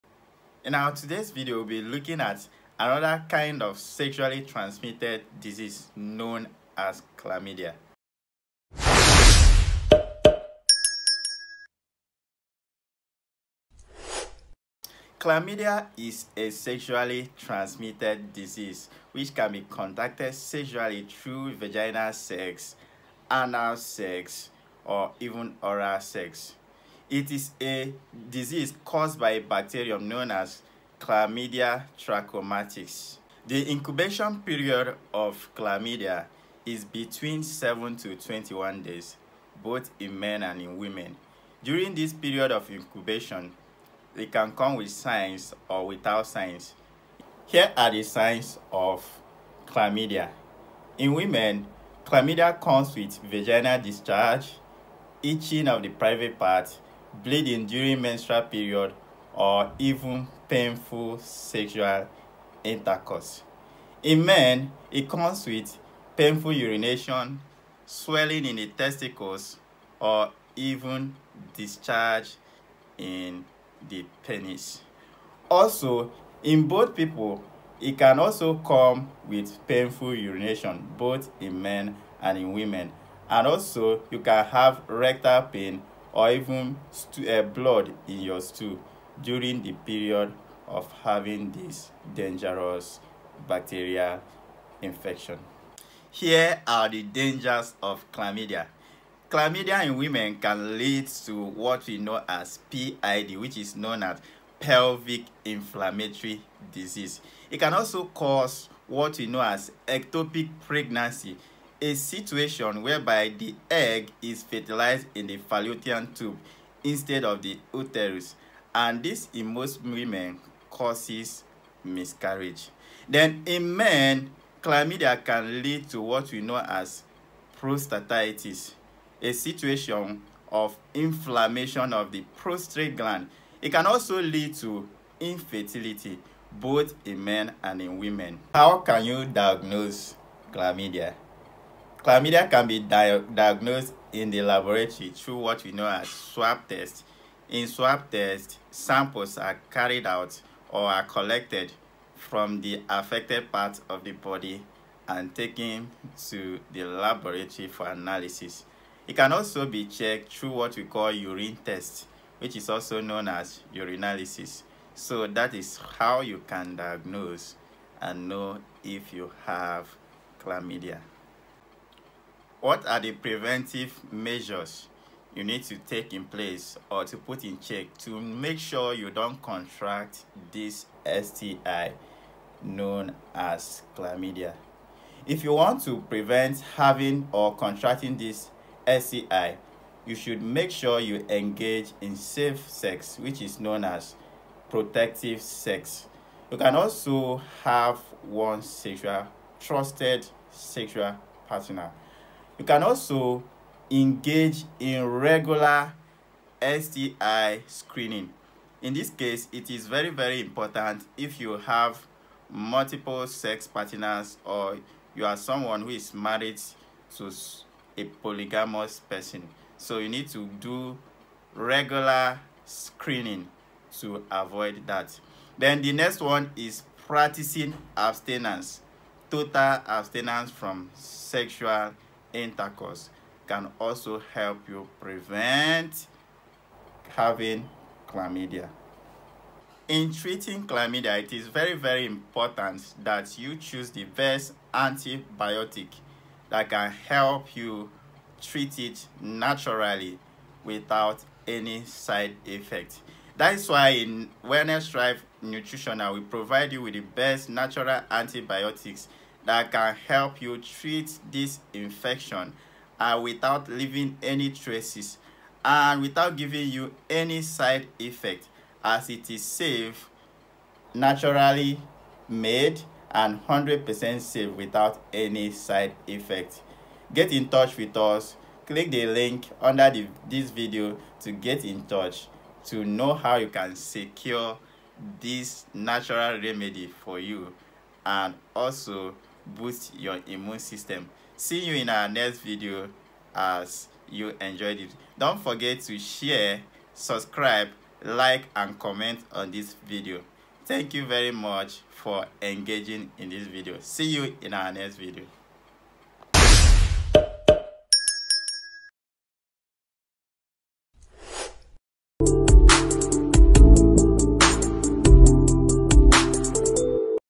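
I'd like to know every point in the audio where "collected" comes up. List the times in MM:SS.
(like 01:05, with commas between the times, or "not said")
02:31.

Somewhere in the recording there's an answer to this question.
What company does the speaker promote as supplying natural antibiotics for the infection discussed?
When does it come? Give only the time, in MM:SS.
04:14.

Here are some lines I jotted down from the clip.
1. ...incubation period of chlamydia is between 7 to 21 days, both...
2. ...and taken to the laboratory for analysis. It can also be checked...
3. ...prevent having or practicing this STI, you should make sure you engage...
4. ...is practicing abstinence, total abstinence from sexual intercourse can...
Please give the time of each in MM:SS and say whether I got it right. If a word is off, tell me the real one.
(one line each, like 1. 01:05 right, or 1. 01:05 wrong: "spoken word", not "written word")
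1. 00:33 right
2. 02:35 right
3. 03:06 wrong: "contracting", not "practicing"
4. 03:46 right.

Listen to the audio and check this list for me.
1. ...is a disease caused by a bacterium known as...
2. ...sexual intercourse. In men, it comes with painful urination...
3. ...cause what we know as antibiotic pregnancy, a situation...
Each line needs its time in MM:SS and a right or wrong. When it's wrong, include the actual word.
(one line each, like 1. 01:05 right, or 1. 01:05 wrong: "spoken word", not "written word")
1. 00:27 right
2. 01:01 right
3. 01:48 wrong: "ectopic", not "antibiotic".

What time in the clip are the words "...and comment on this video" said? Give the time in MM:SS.
04:58.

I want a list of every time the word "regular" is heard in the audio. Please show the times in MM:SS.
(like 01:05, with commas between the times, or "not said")
03:25, 03:41.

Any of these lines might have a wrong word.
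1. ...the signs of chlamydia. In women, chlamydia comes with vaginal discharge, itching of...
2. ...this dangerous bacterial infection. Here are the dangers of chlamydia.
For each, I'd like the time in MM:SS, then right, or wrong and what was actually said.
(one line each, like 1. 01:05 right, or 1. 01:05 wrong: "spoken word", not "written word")
1. 00:47 right
2. 01:31 right.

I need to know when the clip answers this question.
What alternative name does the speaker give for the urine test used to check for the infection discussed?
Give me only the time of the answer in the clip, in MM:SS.
02:43.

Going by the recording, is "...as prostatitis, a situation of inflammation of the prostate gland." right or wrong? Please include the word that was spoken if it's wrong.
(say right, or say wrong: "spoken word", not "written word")
right.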